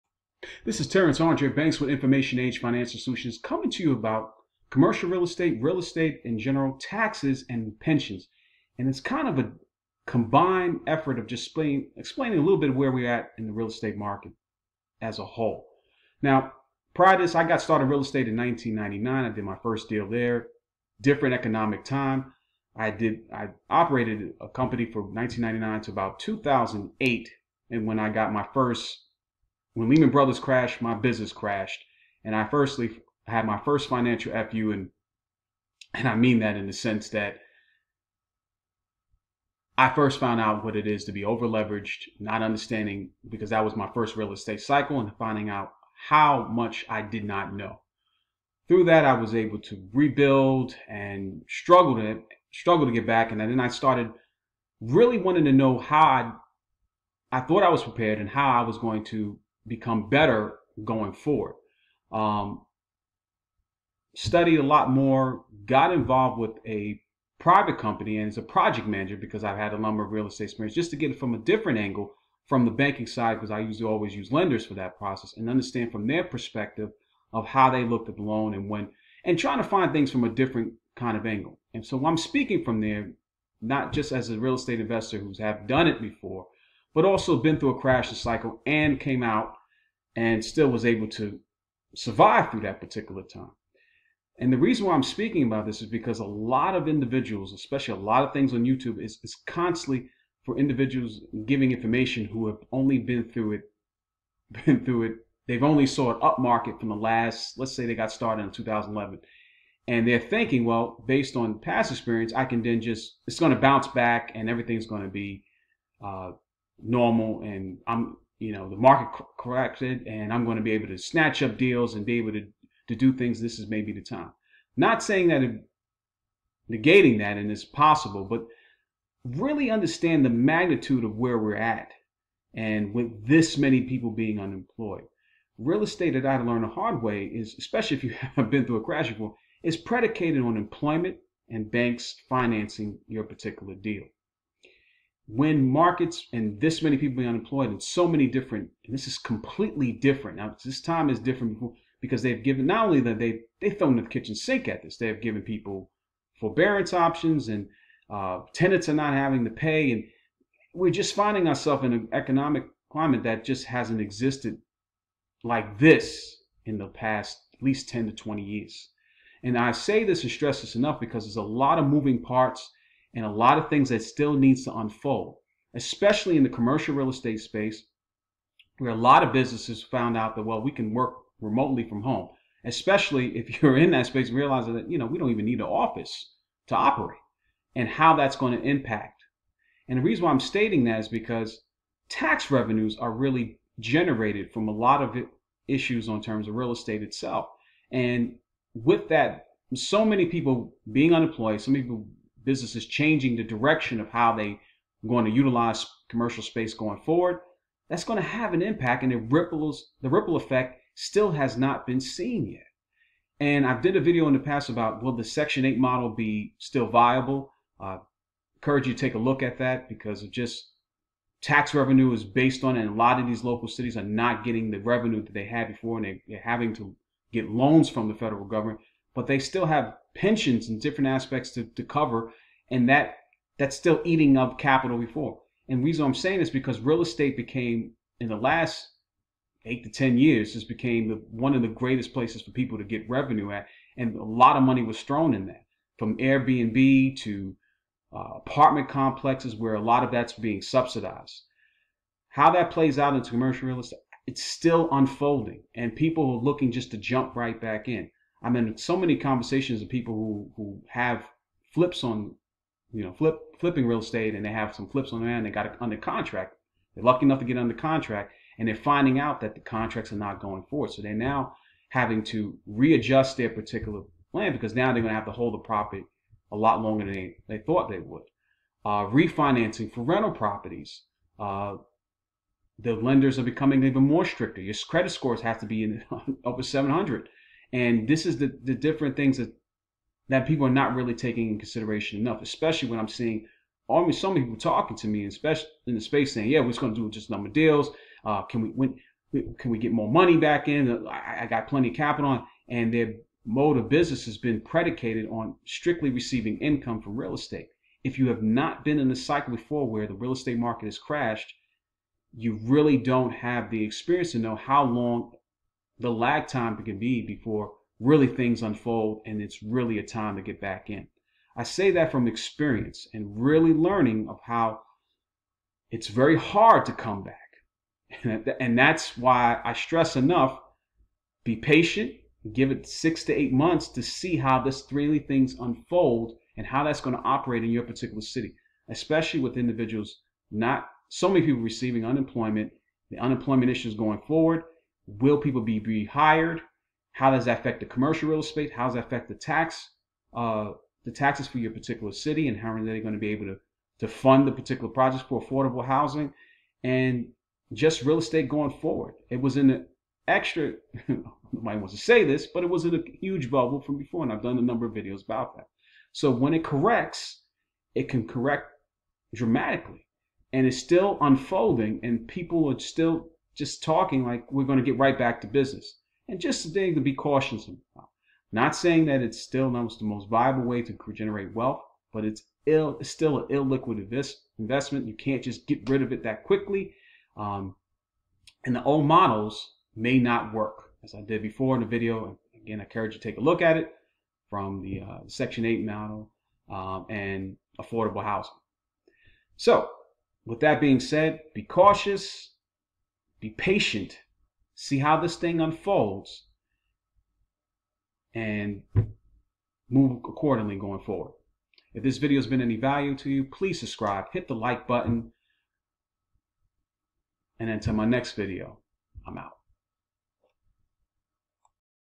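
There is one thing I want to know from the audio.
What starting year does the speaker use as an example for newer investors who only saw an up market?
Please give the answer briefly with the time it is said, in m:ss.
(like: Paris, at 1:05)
2011, at 1:48.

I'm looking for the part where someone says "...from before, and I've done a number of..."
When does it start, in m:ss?
6:03.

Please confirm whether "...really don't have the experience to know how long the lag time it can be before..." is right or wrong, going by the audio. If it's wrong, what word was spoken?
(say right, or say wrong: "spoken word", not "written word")
right.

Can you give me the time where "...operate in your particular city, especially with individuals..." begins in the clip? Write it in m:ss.
5:37.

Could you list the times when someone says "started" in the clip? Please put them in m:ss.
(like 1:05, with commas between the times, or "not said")
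0:17, 0:53, 1:48.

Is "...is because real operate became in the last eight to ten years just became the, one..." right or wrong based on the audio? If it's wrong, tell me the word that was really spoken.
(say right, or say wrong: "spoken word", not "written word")
wrong: "estate", not "operate".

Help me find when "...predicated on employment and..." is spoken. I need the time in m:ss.
2:19.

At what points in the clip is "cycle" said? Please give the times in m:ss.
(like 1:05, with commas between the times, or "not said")
0:44, 1:28, 5:09.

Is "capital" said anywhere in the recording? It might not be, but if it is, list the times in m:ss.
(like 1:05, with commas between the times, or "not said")
3:54, 5:01.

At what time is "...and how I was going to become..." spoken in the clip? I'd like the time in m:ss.
0:58.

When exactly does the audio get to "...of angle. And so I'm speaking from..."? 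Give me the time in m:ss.
1:21.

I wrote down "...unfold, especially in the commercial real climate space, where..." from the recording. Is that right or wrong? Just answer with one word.
wrong.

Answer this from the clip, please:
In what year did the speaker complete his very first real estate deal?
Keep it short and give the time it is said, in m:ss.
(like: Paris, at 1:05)
1999, at 0:17.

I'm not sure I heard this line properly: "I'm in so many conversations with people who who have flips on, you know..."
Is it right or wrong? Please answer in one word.
right.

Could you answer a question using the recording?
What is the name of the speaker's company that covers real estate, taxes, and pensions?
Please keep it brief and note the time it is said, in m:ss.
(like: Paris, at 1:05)
Information Age Financial Solutions, at 0:01.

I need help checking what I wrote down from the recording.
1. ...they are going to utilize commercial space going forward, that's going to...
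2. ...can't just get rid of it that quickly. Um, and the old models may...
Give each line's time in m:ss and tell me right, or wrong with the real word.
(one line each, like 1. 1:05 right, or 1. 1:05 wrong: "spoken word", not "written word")
1. 3:24 right
2. 6:25 right.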